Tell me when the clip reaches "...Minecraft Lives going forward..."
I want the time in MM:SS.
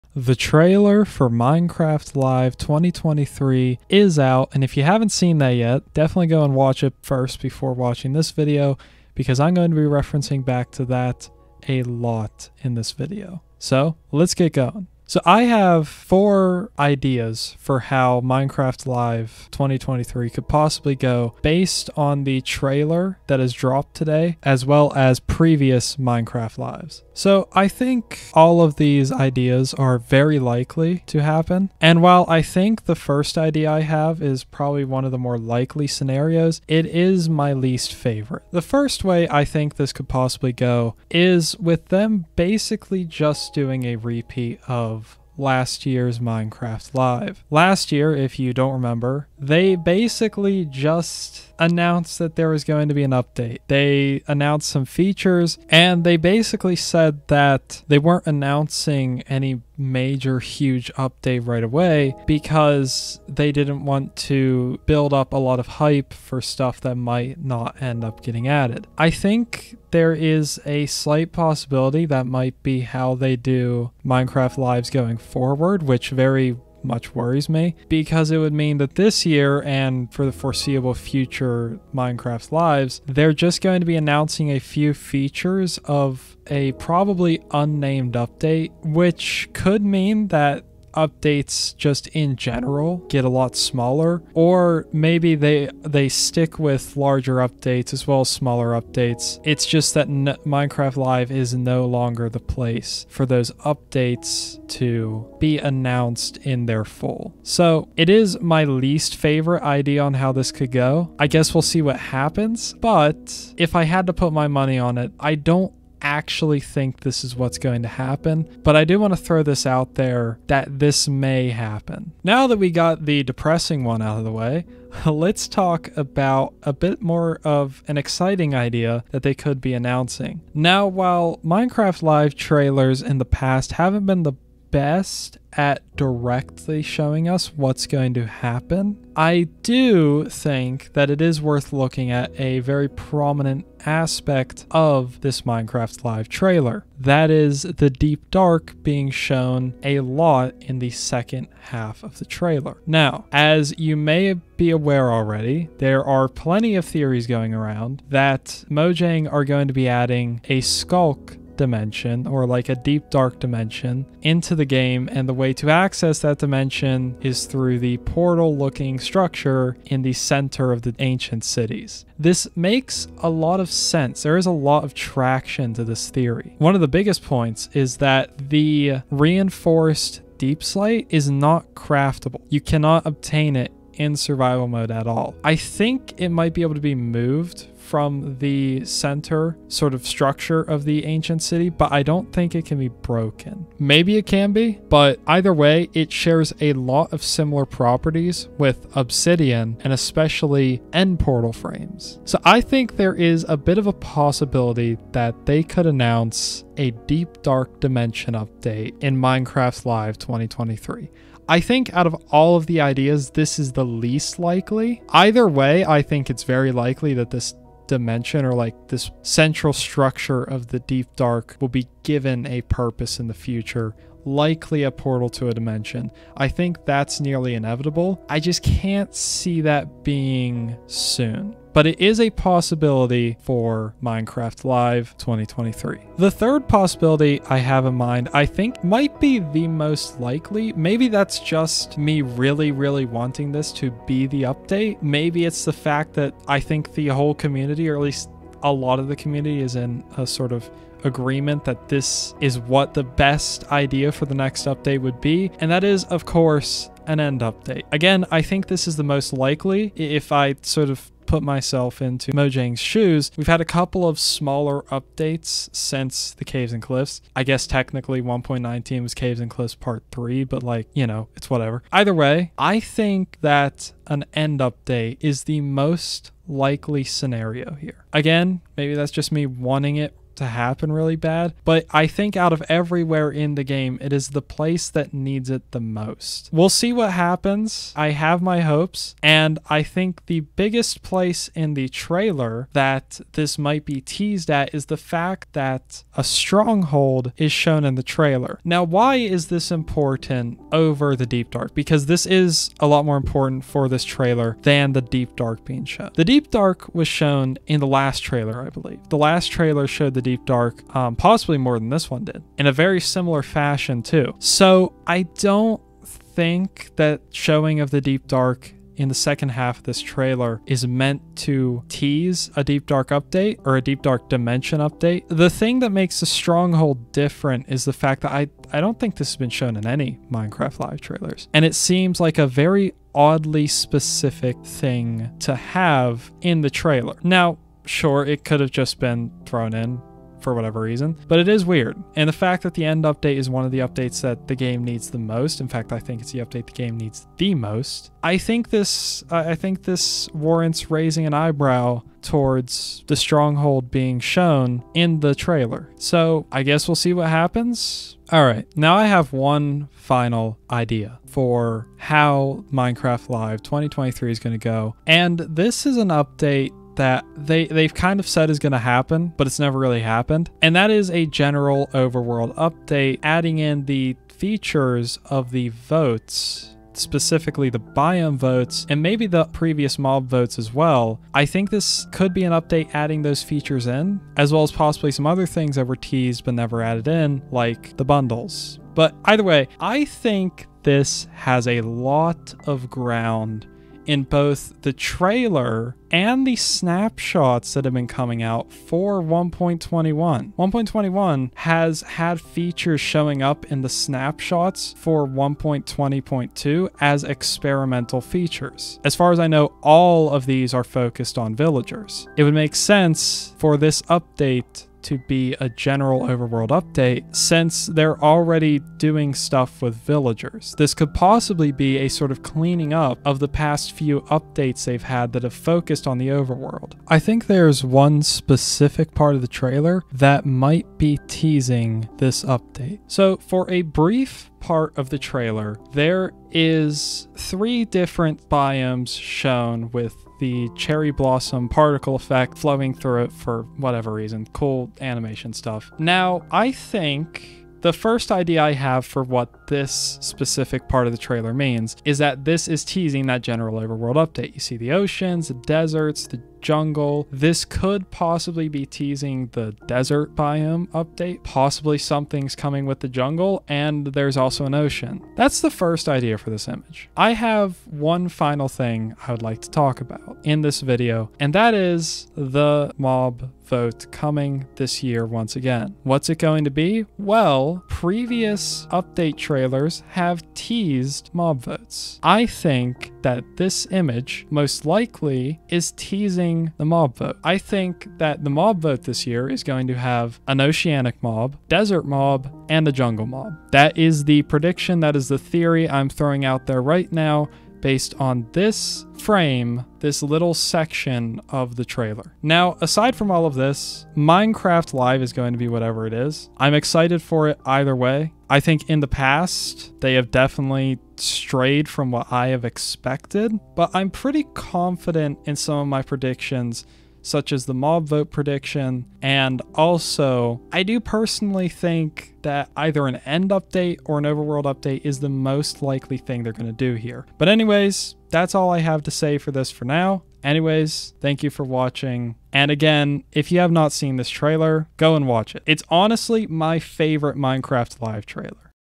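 01:14.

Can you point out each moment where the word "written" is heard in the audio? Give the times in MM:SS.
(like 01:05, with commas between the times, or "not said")
not said.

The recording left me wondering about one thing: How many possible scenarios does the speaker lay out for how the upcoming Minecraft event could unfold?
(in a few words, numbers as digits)
4.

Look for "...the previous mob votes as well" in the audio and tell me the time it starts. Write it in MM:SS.
06:19.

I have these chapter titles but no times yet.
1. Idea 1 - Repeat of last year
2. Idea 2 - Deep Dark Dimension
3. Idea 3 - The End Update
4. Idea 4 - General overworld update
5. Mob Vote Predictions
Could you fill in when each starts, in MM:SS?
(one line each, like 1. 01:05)
1. 00:38
2. 02:09
3. 03:55
4. 05:58
5. 07:47.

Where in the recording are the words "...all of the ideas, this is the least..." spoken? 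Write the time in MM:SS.
03:32.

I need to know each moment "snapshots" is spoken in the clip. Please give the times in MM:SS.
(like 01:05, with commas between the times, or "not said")
06:36, 06:43.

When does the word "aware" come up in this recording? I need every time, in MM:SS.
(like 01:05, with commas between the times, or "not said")
02:34.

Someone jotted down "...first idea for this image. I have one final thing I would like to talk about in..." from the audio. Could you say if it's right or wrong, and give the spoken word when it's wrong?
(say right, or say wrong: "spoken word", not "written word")
right.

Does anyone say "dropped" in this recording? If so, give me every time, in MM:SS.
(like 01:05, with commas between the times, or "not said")
00:23.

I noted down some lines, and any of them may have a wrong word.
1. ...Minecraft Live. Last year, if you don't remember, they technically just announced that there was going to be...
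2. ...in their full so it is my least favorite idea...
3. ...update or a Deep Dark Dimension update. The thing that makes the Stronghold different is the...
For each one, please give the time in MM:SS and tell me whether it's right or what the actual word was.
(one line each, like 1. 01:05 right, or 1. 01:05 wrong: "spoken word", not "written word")
1. 00:46 wrong: "basically", not "technically"
2. 01:46 right
3. 05:23 right.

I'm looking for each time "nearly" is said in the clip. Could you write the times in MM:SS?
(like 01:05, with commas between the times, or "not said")
03:47.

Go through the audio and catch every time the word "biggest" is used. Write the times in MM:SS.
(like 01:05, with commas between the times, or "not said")
02:56, 04:50.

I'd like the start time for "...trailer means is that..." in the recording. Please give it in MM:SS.
07:31.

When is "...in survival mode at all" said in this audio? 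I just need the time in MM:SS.
03:03.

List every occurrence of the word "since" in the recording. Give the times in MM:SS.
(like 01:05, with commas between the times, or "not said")
04:25, 06:57.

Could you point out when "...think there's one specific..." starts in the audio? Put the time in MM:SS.
07:07.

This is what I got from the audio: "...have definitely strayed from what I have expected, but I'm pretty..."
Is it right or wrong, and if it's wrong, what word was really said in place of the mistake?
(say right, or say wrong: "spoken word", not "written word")
right.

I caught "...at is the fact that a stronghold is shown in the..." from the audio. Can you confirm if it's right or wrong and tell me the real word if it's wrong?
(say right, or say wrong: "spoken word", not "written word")
right.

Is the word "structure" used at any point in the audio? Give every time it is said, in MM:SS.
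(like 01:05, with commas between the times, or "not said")
02:48, 03:10, 03:39.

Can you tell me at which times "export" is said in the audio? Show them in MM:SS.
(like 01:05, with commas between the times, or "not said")
not said.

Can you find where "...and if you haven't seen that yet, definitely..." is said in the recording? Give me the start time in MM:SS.
00:04.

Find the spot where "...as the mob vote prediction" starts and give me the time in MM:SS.
08:37.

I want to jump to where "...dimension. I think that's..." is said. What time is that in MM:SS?
03:45.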